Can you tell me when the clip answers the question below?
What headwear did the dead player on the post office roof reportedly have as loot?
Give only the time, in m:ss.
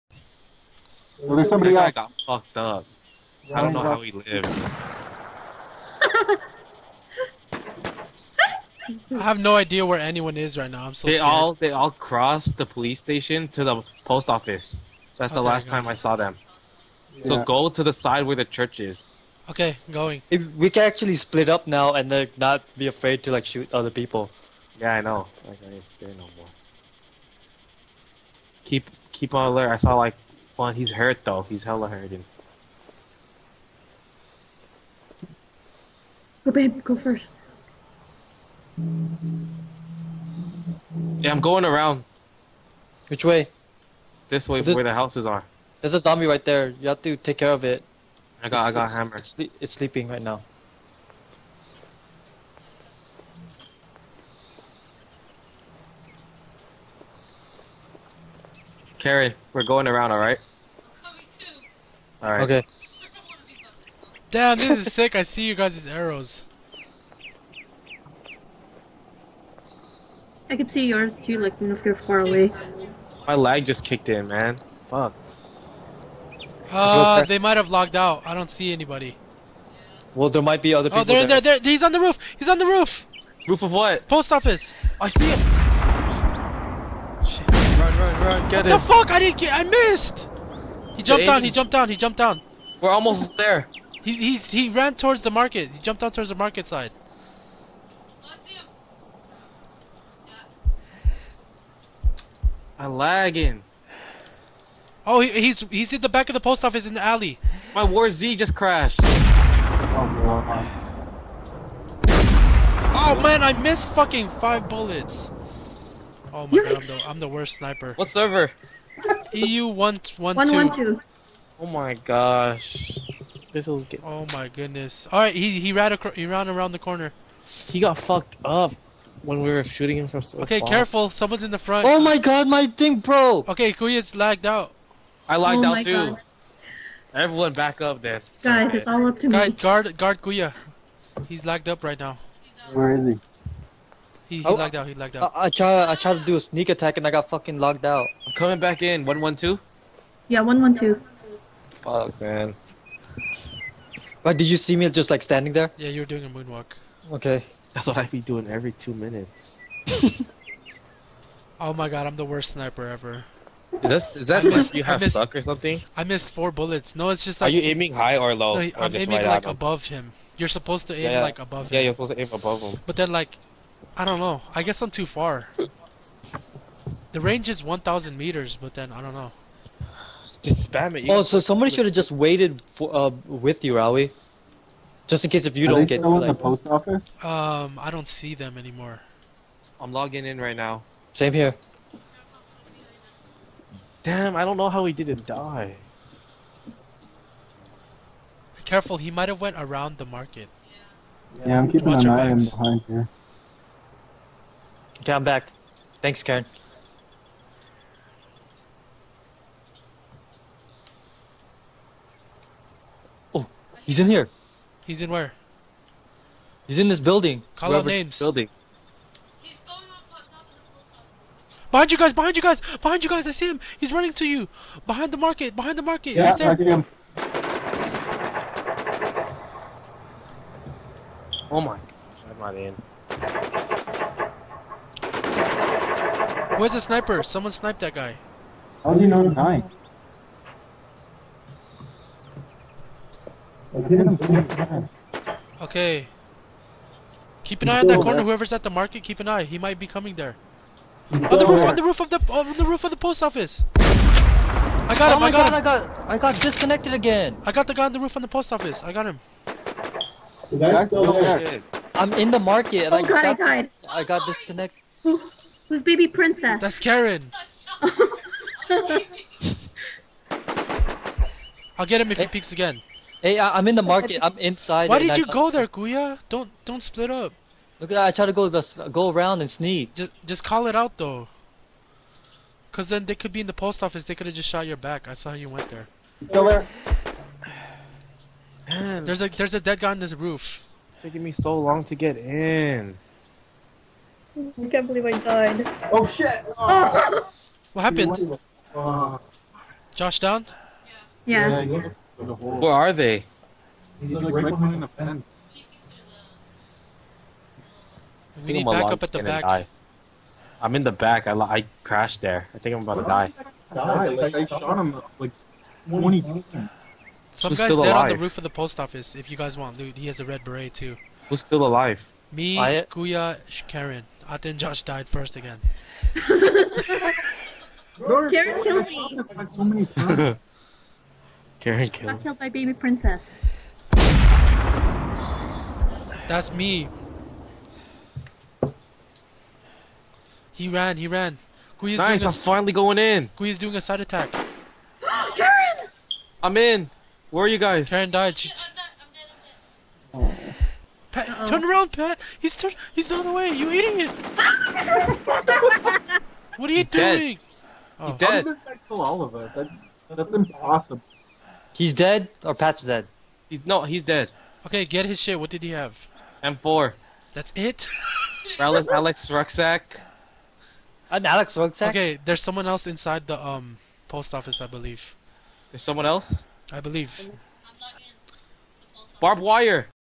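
5:20.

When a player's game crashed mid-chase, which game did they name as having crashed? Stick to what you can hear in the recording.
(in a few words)
War Z.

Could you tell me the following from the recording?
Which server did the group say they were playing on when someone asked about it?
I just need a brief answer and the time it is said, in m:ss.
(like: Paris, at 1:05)
EU 1112, at 1:59.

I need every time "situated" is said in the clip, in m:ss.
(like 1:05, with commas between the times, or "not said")
not said.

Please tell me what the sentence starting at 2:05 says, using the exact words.
All right, he he ran he ran around the corner.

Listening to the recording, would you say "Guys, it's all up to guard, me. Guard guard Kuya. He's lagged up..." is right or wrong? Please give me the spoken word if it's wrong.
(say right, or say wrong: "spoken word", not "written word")
right.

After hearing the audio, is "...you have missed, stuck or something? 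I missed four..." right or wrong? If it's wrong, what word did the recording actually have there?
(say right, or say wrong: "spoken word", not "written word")
right.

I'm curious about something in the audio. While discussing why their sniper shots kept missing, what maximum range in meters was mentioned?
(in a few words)
1,000 meters.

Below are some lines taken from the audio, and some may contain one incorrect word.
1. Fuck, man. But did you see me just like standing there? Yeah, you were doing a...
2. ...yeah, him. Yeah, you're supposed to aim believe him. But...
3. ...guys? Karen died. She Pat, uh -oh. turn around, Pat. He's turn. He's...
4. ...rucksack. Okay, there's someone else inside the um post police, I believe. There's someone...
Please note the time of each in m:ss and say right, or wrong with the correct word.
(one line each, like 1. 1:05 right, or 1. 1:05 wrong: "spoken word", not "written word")
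1. 2:31 right
2. 2:51 wrong: "above", not "believe"
3. 5:47 right
4. 6:11 wrong: "office", not "police".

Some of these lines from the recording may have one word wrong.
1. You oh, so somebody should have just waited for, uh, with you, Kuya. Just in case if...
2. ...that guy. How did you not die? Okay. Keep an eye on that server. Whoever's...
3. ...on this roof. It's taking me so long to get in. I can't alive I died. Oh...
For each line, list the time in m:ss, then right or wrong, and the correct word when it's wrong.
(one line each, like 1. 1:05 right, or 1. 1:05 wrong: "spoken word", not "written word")
1. 3:01 wrong: "Rawie", not "Kuya"
2. 3:57 wrong: "corner", not "server"
3. 4:49 wrong: "believe", not "alive".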